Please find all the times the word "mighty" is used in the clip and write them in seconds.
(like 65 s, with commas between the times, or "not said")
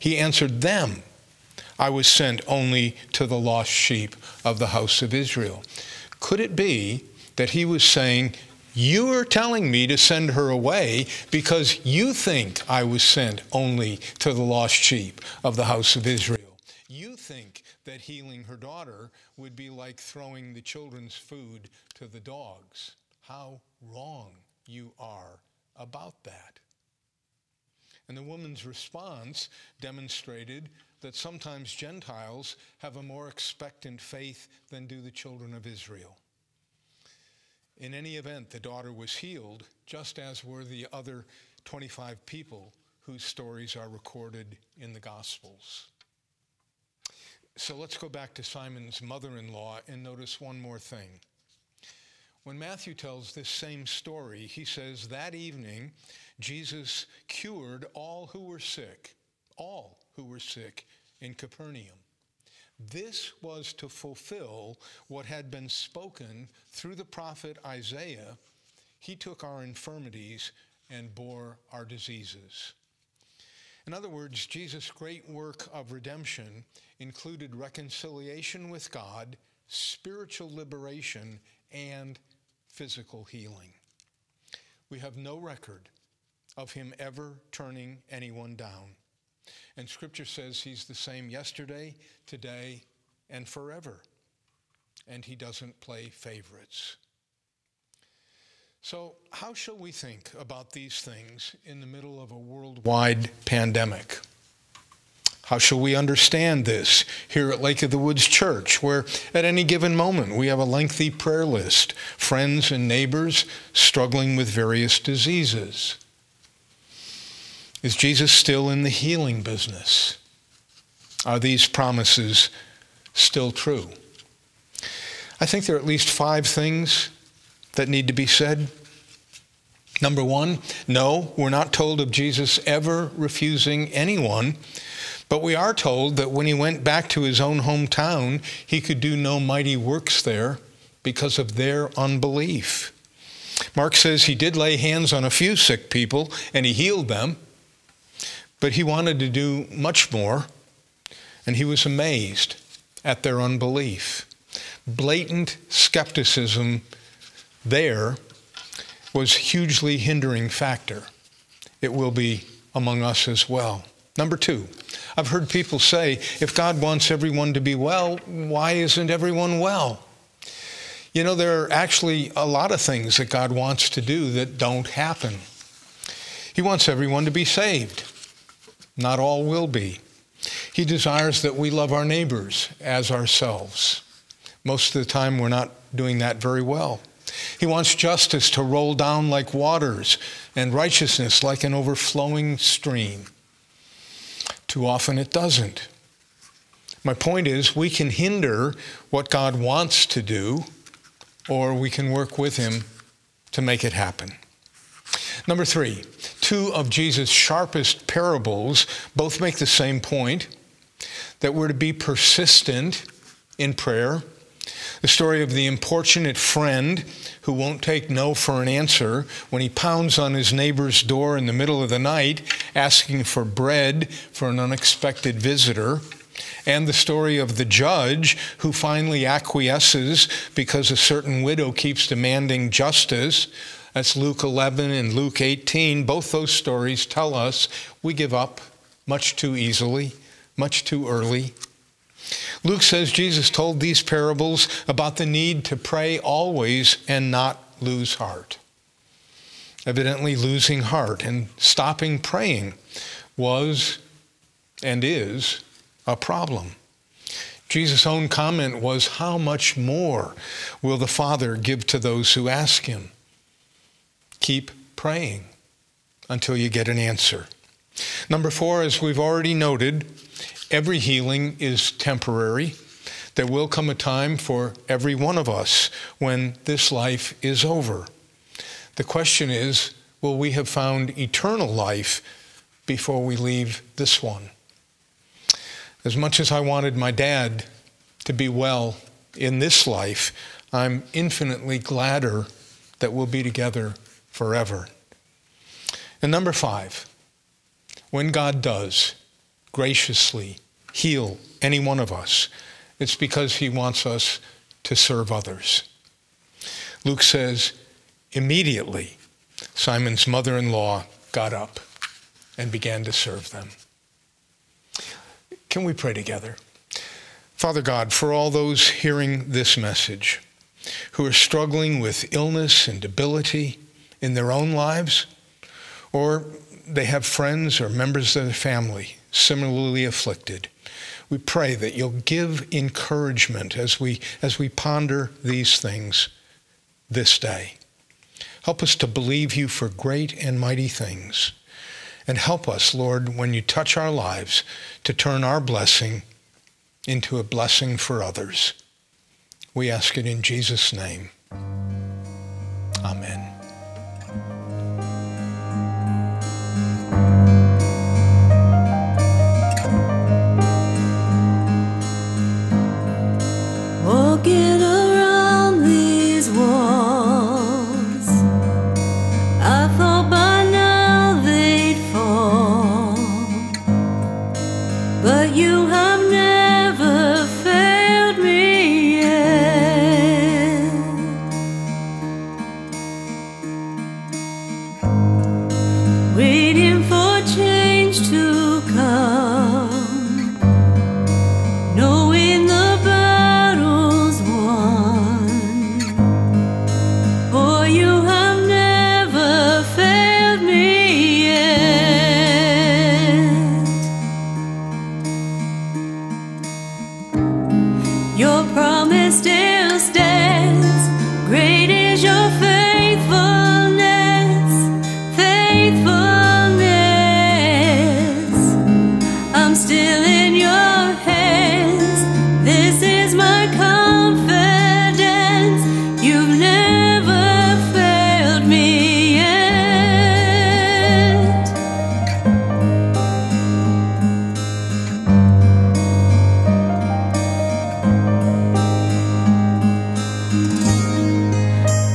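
139 s, 340 s.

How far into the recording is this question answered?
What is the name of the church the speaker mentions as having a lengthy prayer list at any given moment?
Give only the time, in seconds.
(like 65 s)
107 s.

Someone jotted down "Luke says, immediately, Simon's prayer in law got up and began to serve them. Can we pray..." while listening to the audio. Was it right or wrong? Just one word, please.
wrong.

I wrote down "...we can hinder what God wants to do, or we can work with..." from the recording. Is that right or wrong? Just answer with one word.
right.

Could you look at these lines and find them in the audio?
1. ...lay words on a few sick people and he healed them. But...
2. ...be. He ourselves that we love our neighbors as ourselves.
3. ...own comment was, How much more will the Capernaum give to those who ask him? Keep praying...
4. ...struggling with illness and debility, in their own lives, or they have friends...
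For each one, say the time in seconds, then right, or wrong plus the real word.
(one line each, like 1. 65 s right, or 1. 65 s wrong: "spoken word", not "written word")
1. 144 s wrong: "hands", not "words"
2. 179 s wrong: "desires", not "ourselves"
3. 258 s wrong: "Father", not "Capernaum"
4. 321 s right.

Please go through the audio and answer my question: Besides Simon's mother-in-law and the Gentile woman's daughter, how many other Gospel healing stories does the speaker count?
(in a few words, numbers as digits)
25.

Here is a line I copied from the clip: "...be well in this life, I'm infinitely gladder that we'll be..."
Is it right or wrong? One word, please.
right.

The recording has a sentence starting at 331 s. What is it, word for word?
We pray that you'll give encouragement as we, as we ponder these things this day.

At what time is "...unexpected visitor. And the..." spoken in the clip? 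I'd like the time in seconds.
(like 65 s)
224 s.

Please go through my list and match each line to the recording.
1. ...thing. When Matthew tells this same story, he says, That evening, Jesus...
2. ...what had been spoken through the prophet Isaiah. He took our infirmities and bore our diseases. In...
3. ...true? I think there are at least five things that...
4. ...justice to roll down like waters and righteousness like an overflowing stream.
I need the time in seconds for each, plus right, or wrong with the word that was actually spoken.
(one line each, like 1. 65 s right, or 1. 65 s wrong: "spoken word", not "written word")
1. 50 s right
2. 65 s right
3. 123 s right
4. 187 s right.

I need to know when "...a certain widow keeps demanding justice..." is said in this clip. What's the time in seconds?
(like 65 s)
230 s.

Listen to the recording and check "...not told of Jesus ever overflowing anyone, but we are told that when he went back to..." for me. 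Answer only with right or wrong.
wrong.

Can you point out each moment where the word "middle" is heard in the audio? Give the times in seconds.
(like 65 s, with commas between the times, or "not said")
101 s, 221 s.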